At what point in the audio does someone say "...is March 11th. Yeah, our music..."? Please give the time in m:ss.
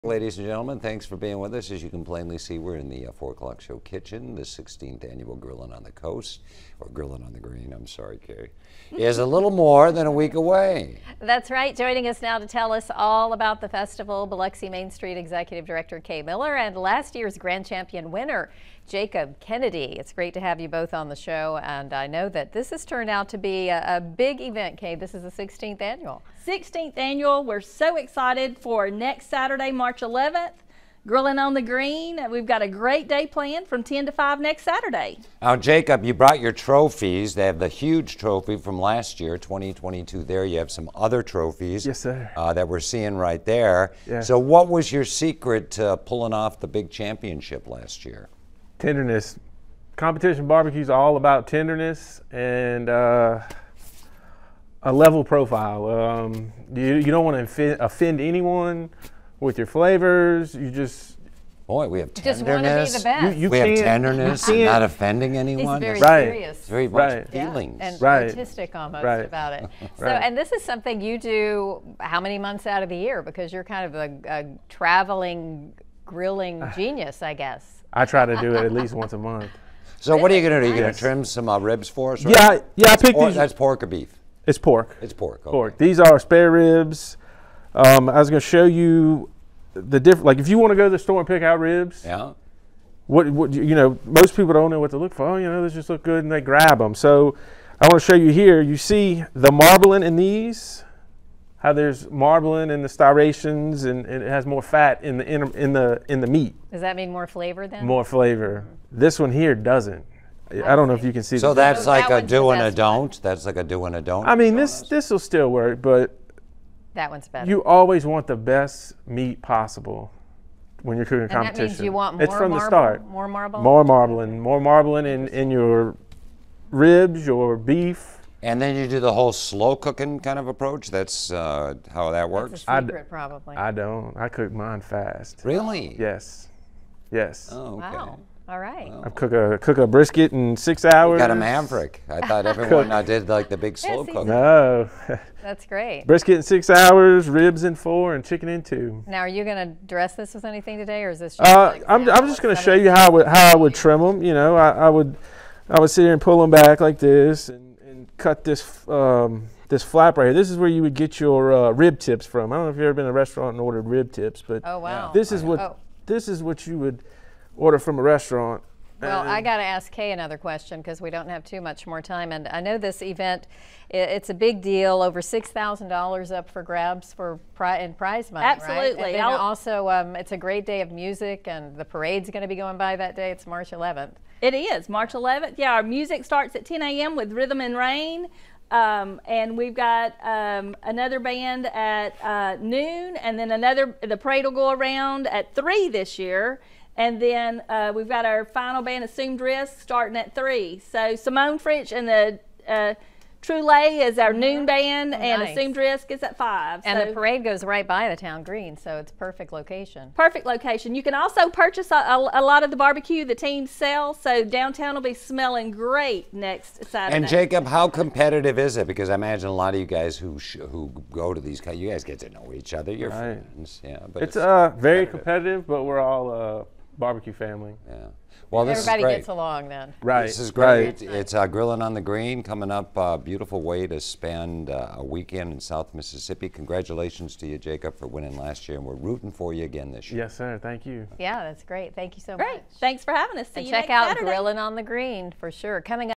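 3:04.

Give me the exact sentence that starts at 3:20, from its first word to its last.
So Simone French and the uh, Lay is our noon mm-hmm.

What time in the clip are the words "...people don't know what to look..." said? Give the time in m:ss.
1:34.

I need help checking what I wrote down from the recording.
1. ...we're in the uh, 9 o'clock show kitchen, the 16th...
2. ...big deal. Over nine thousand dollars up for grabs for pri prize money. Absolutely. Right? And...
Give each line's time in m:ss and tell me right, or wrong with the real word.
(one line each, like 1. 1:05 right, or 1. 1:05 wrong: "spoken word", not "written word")
1. 0:02 wrong: "4", not "9"
2. 2:54 wrong: "six", not "nine".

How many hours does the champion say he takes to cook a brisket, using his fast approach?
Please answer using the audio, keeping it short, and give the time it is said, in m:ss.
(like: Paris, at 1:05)
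6, at 2:19.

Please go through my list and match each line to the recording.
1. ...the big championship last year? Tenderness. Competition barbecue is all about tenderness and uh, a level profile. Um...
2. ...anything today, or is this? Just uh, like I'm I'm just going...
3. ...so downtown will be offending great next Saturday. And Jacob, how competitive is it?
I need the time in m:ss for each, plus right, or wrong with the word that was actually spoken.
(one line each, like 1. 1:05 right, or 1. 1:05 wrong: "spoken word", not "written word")
1. 0:46 right
2. 2:30 right
3. 3:34 wrong: "smelling", not "offending".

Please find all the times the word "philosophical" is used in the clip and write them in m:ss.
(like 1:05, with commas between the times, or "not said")
not said.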